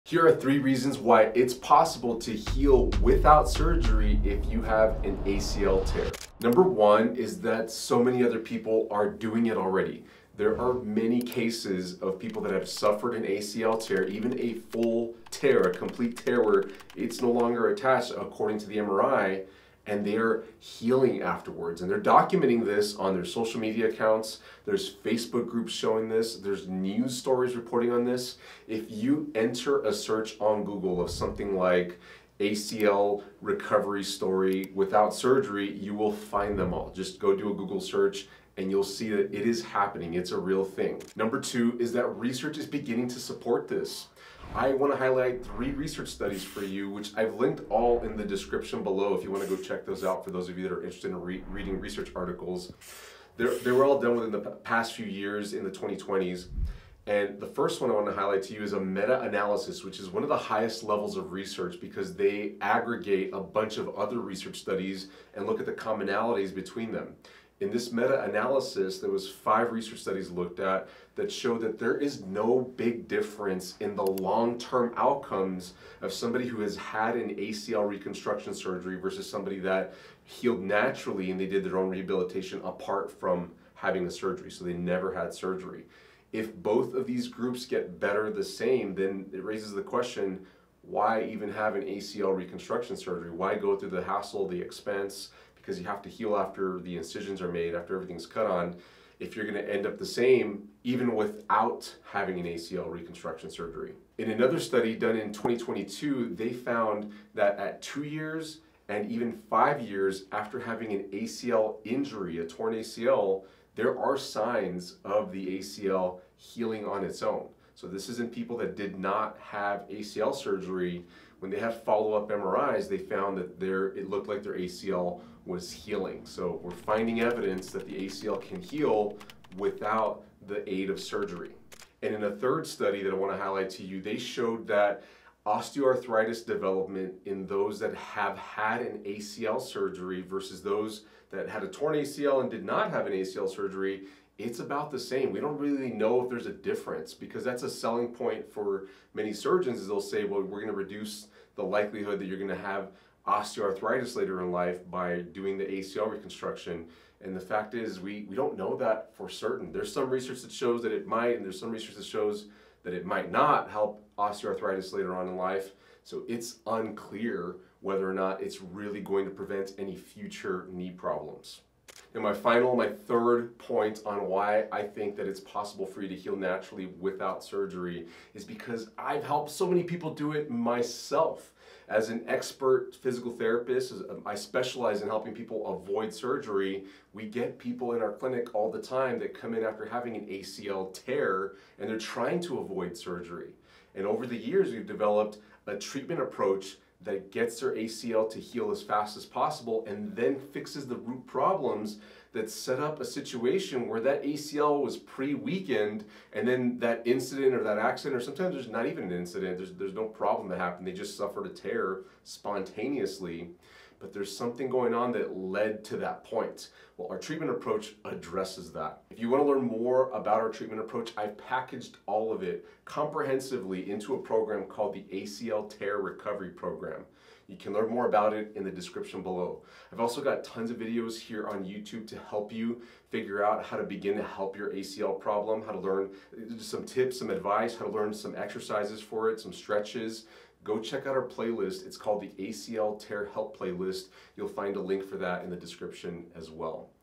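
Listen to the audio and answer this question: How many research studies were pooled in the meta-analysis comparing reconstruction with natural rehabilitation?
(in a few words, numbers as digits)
5.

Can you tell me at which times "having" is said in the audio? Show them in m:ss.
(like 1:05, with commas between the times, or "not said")
1:23, 1:42, 1:50, 3:09.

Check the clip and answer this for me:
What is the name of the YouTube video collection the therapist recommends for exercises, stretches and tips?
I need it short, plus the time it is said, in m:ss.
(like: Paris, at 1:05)
ACL Tear Help Playlist, at 4:02.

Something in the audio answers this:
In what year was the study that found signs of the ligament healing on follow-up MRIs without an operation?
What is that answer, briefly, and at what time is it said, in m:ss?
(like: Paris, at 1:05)
2022, at 1:45.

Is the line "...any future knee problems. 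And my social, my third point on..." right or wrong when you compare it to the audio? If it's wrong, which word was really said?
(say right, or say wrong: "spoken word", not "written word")
wrong: "final", not "social".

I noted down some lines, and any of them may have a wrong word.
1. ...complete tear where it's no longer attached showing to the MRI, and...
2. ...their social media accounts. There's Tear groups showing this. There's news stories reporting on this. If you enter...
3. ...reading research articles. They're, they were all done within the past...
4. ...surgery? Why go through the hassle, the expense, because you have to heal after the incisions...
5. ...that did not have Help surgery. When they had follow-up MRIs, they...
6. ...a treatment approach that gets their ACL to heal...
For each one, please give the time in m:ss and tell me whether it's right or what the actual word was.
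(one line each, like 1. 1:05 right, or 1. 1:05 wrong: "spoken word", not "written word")
1. 0:15 wrong: "according", not "showing"
2. 0:23 wrong: "Facebook", not "Tear"
3. 0:51 right
4. 1:32 right
5. 1:58 wrong: "ACL", not "Help"
6. 3:15 right.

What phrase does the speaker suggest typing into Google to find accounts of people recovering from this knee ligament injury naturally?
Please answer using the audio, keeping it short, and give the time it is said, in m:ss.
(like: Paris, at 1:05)
ACL recovery story without surgery, at 0:32.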